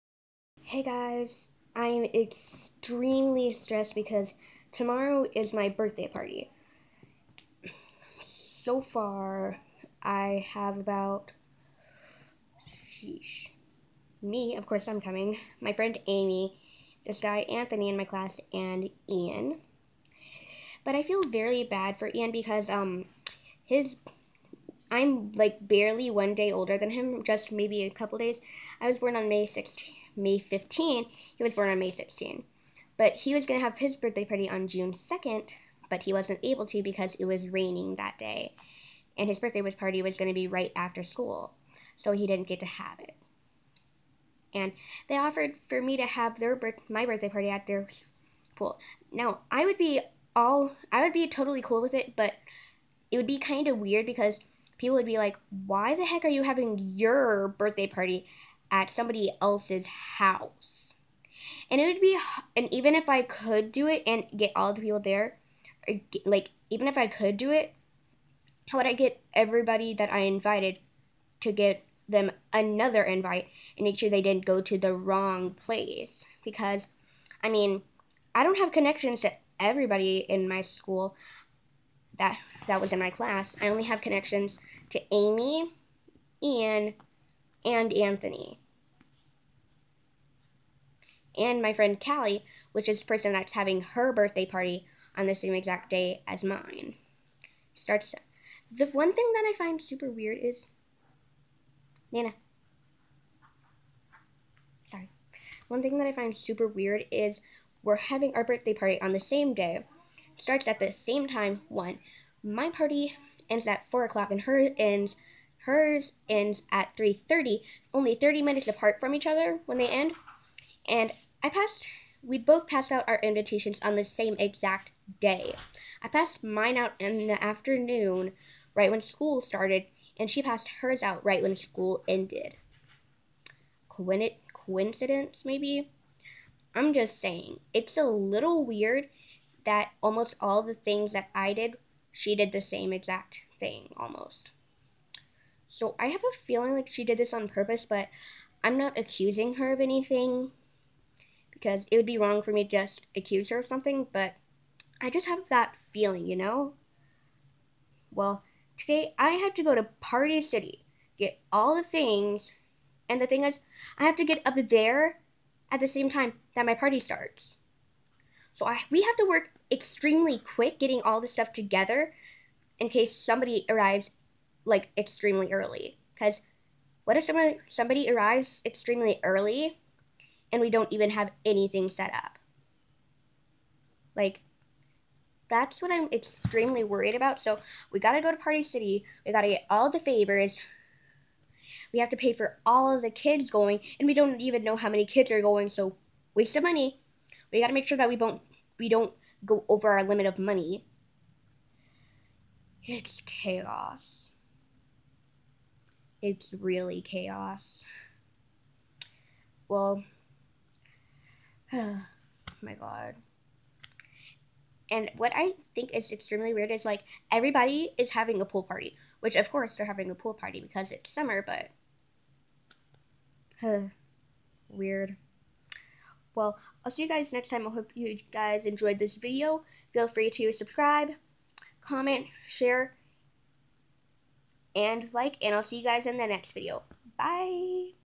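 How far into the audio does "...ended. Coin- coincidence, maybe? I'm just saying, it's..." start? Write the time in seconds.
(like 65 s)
132 s.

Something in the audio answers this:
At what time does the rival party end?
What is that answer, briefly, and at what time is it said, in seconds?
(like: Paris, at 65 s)
3:30, at 116 s.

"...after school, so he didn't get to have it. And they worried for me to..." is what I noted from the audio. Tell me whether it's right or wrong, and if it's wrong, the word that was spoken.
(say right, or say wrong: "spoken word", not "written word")
wrong: "offered", not "worried".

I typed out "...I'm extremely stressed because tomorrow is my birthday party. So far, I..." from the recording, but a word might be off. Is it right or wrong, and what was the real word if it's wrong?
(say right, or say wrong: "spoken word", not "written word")
right.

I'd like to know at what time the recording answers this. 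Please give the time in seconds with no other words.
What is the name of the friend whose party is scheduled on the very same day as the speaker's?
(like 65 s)
91 s.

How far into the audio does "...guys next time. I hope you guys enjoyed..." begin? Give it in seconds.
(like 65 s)
227 s.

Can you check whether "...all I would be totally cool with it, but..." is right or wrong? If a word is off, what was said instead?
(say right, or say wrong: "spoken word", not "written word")
right.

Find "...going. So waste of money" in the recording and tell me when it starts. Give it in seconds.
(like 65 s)
195 s.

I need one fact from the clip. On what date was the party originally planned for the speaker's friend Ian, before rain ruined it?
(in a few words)
June 2nd.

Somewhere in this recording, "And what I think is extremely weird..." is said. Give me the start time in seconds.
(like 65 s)
214 s.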